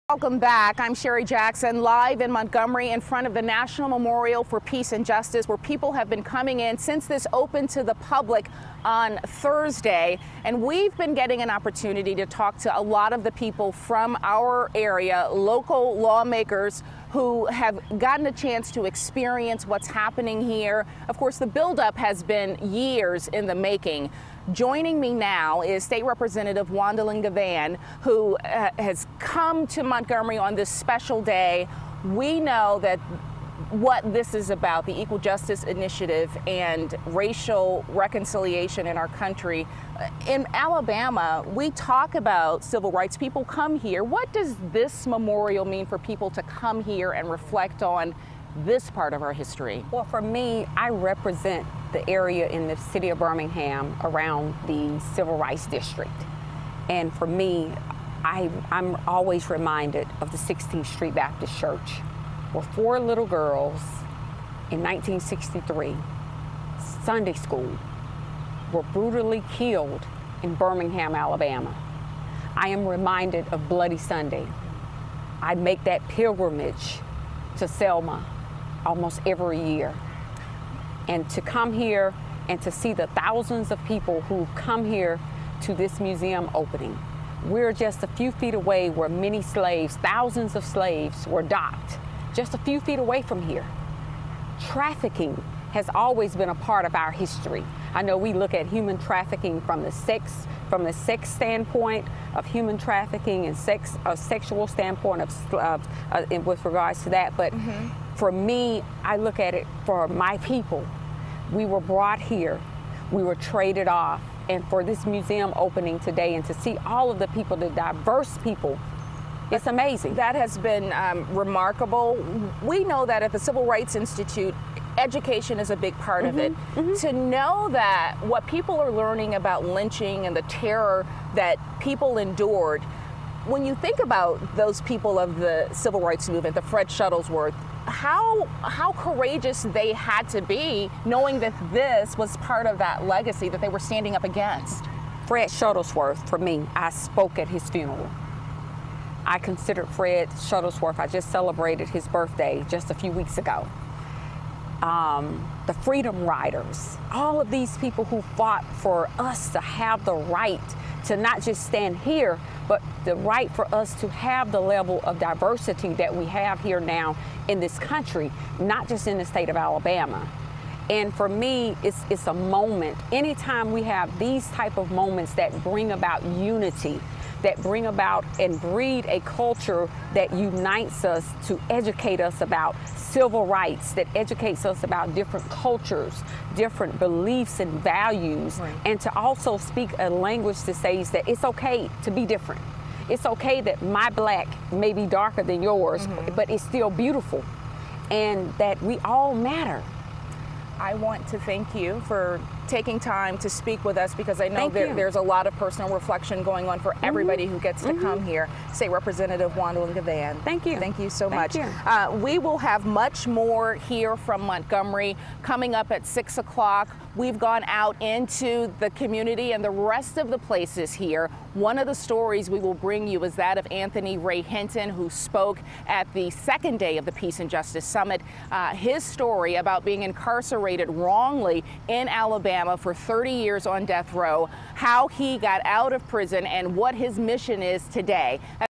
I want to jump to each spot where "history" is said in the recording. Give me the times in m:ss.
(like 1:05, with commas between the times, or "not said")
0:49, 1:37.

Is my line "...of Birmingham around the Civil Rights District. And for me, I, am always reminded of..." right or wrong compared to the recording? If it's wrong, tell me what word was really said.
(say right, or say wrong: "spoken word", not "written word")
right.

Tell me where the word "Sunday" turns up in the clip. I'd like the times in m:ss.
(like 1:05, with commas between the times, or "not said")
1:07, 1:13.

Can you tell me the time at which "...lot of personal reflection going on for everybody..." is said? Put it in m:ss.
3:25.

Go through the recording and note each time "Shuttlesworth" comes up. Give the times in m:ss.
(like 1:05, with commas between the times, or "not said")
2:16, 2:25, 2:30.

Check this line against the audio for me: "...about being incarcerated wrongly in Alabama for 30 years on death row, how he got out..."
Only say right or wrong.
right.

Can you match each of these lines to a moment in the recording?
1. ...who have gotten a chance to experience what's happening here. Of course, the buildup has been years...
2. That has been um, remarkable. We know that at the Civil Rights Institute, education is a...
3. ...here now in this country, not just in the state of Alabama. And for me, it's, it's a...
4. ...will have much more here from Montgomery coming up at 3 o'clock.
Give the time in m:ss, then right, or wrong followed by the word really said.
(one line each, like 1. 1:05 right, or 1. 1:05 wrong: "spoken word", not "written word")
1. 0:17 right
2. 2:00 right
3. 2:46 right
4. 3:32 wrong: "6", not "3".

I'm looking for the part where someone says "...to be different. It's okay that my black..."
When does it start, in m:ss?
3:12.